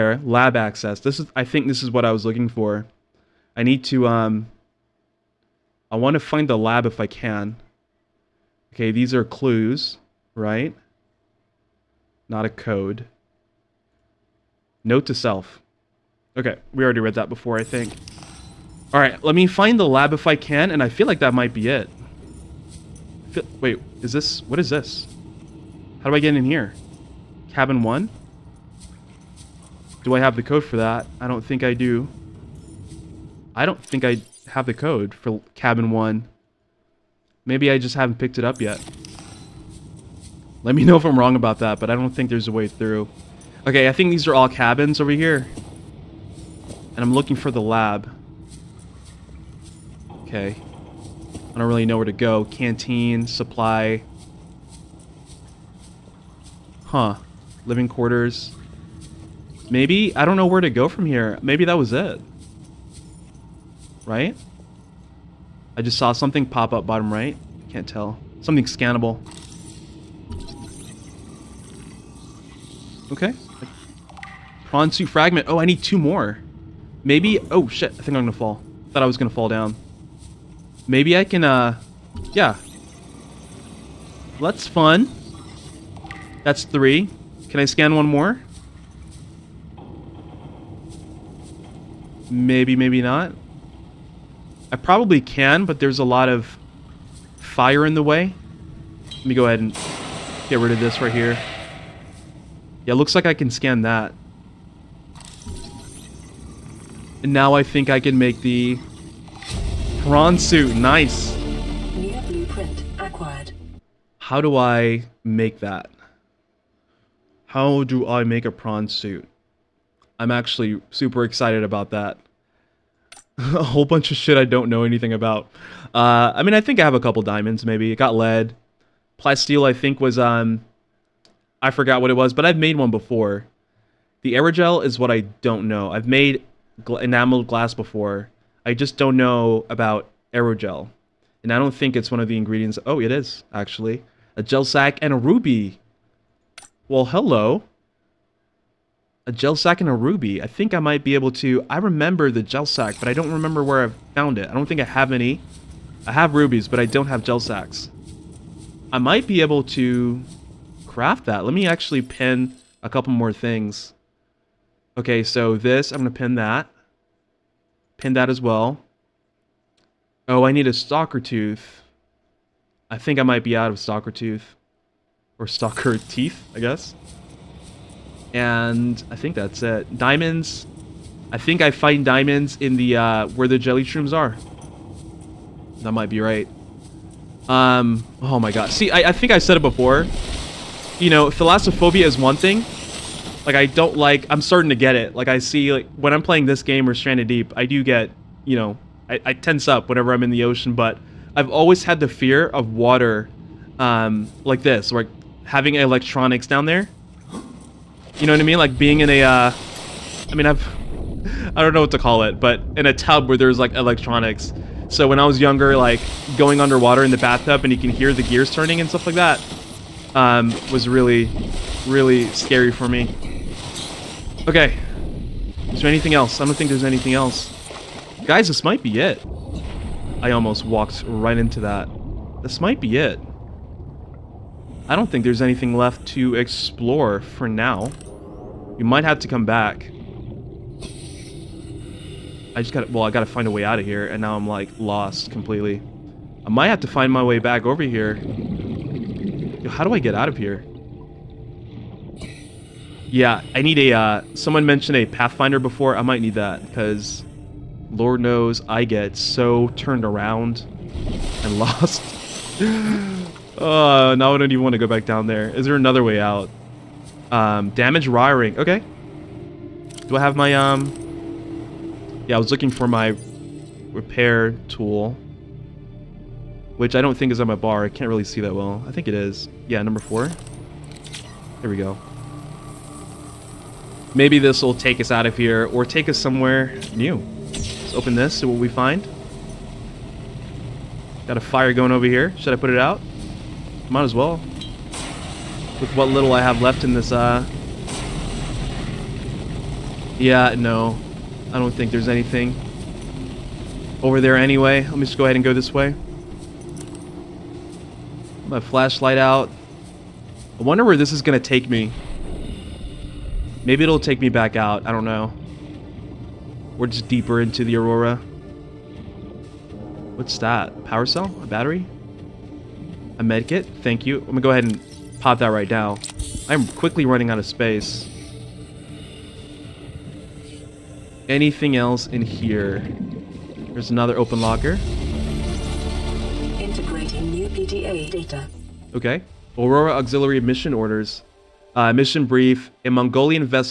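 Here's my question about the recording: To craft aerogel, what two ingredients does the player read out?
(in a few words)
A gel sac and a ruby.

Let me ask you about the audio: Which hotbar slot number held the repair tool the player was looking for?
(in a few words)
4.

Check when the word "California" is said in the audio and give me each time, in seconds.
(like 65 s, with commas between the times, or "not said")
not said.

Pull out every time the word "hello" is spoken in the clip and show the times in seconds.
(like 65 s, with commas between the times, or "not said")
147 s.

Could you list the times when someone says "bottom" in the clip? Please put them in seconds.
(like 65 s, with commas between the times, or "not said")
66 s.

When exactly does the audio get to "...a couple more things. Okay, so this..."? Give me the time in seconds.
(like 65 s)
162 s.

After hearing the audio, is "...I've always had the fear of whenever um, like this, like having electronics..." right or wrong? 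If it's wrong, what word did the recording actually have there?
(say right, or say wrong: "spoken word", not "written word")
wrong: "water", not "whenever".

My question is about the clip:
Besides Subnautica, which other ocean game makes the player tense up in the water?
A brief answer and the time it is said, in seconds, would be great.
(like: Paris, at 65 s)
Stranded Deep, at 196 s.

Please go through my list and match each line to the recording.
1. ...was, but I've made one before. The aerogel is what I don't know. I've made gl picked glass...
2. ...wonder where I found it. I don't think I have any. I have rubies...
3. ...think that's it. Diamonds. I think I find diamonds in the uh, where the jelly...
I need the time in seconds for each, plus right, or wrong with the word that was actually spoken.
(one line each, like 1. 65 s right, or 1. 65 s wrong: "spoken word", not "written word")
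1. 132 s wrong: "enameled", not "picked"
2. 153 s wrong: "remember", not "wonder"
3. 179 s right.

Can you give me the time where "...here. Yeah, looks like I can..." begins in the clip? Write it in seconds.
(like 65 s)
101 s.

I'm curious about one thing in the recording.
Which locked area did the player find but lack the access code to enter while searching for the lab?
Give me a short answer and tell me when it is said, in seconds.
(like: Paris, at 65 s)
Cabin 1, at 27 s.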